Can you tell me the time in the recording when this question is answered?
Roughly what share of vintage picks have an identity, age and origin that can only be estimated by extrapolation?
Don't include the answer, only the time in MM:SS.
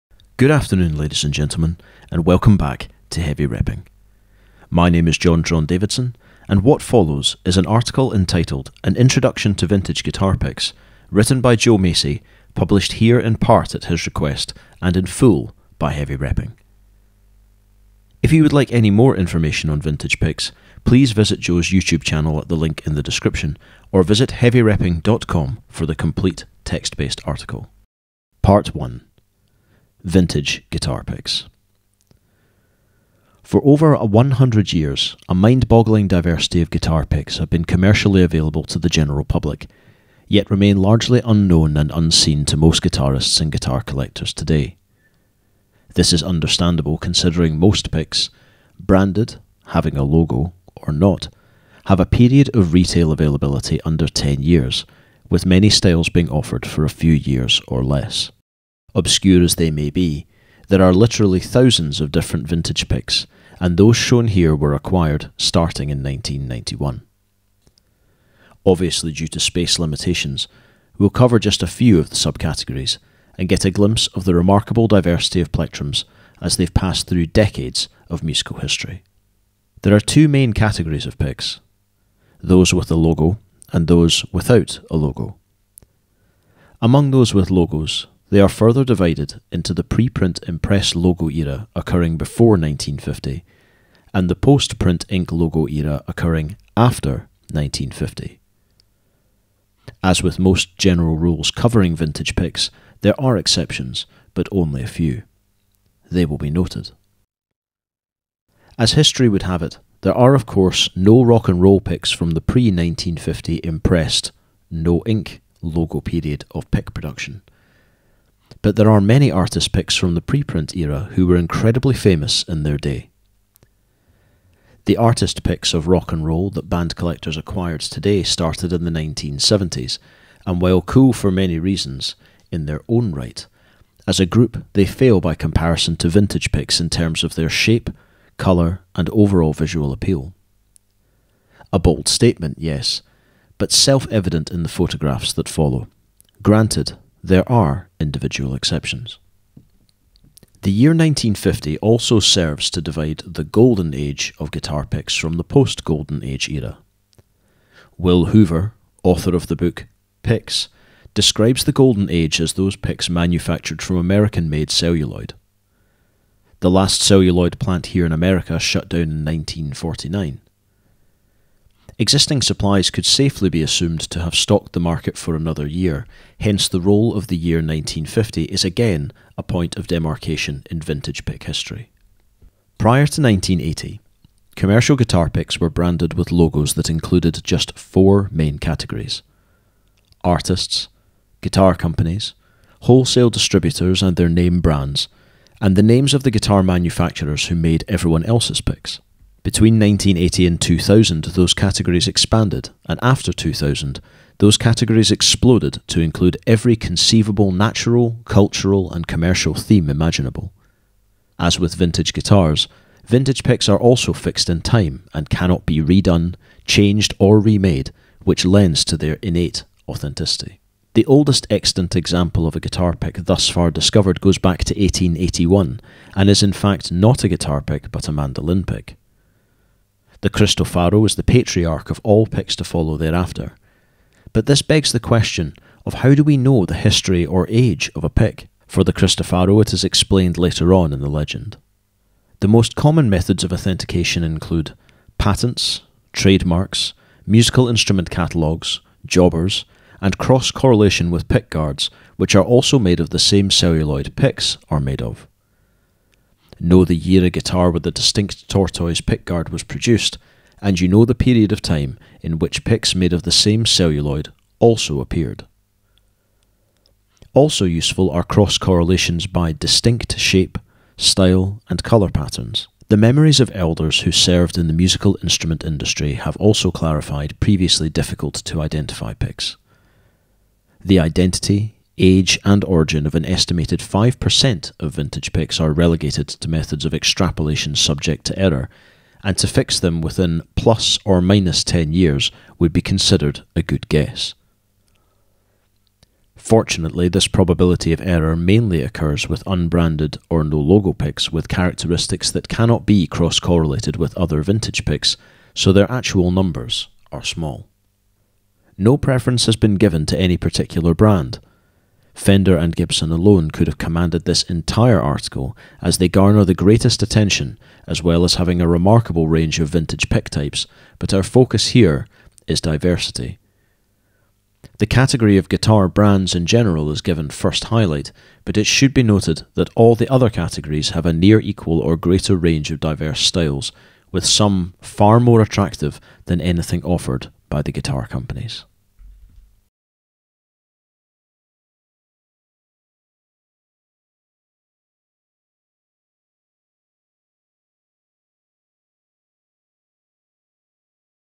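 04:43.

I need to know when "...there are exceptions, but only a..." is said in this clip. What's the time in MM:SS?
01:43.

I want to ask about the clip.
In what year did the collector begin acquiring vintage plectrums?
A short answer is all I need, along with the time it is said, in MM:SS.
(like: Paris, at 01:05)
1991, at 01:06.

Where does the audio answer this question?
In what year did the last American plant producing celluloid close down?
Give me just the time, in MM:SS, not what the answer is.
02:49.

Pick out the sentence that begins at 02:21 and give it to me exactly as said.
A bold statement, yes, but self evident in the photographs that follow.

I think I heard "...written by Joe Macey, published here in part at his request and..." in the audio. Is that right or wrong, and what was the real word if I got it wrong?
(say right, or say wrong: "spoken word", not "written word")
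right.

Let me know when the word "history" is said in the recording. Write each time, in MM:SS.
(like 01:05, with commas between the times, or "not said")
01:18, 01:48, 03:01, 03:56.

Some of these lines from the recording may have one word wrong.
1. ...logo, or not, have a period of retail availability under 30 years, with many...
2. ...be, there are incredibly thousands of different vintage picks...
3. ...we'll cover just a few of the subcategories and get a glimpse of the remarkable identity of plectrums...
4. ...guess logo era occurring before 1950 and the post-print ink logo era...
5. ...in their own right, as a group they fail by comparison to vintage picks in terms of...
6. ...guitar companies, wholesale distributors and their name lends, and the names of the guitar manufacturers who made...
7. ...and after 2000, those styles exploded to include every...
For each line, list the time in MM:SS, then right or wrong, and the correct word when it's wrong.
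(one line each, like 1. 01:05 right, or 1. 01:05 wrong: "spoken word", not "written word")
1. 00:50 wrong: "10", not "30"
2. 00:59 wrong: "literally", not "incredibly"
3. 01:10 wrong: "diversity", not "identity"
4. 01:30 wrong: "impress", not "guess"
5. 02:12 right
6. 03:11 wrong: "brands", not "lends"
7. 03:22 wrong: "categories", not "styles".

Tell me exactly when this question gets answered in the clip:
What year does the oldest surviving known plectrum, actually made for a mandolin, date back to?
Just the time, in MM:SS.
03:44.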